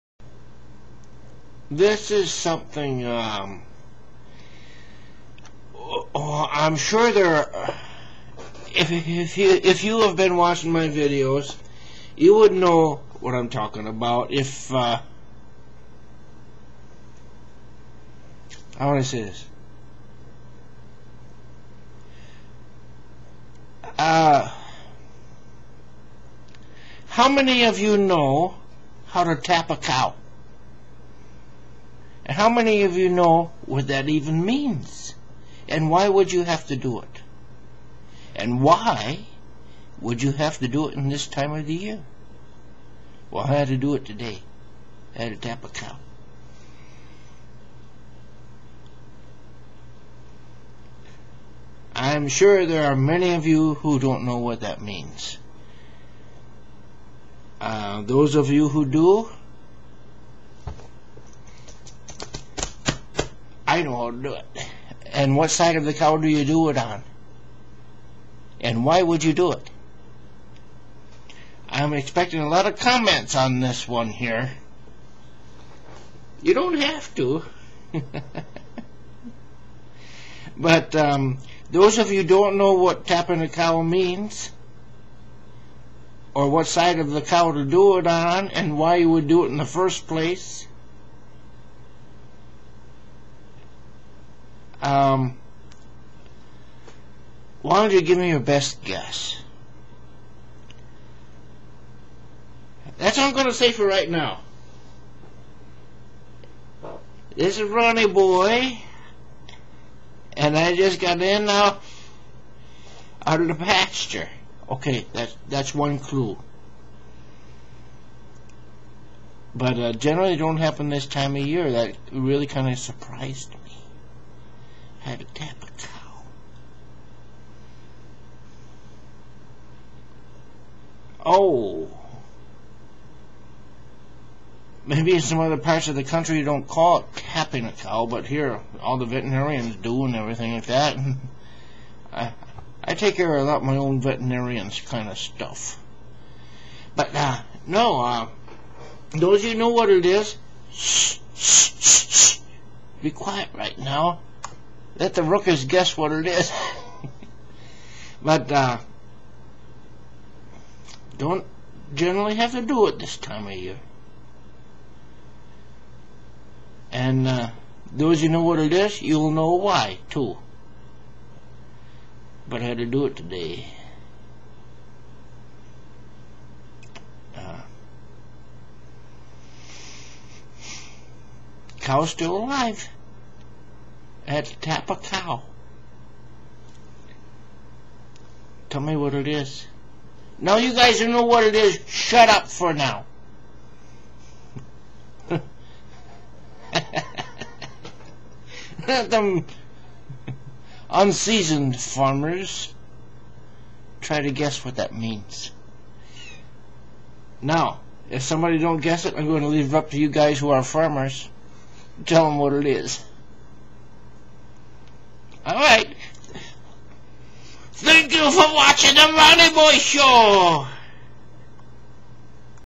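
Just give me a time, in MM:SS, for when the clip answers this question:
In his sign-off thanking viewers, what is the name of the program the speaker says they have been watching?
03:39.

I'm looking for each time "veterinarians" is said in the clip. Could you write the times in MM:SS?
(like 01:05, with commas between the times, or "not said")
02:19, 02:24.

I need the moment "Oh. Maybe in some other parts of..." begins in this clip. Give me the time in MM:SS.
02:11.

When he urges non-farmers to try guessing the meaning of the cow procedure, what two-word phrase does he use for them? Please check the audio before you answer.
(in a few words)
unseasoned farmers.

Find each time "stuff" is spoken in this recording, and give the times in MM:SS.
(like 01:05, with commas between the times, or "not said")
02:25.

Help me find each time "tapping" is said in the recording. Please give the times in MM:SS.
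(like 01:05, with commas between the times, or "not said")
01:23, 02:17.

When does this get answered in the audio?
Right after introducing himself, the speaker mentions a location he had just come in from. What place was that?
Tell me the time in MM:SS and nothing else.
01:53.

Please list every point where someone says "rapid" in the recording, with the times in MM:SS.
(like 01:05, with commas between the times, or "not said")
not said.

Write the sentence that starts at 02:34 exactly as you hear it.
Let the rookers guess what it is.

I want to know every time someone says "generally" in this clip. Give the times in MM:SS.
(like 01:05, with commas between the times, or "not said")
01:59, 02:41.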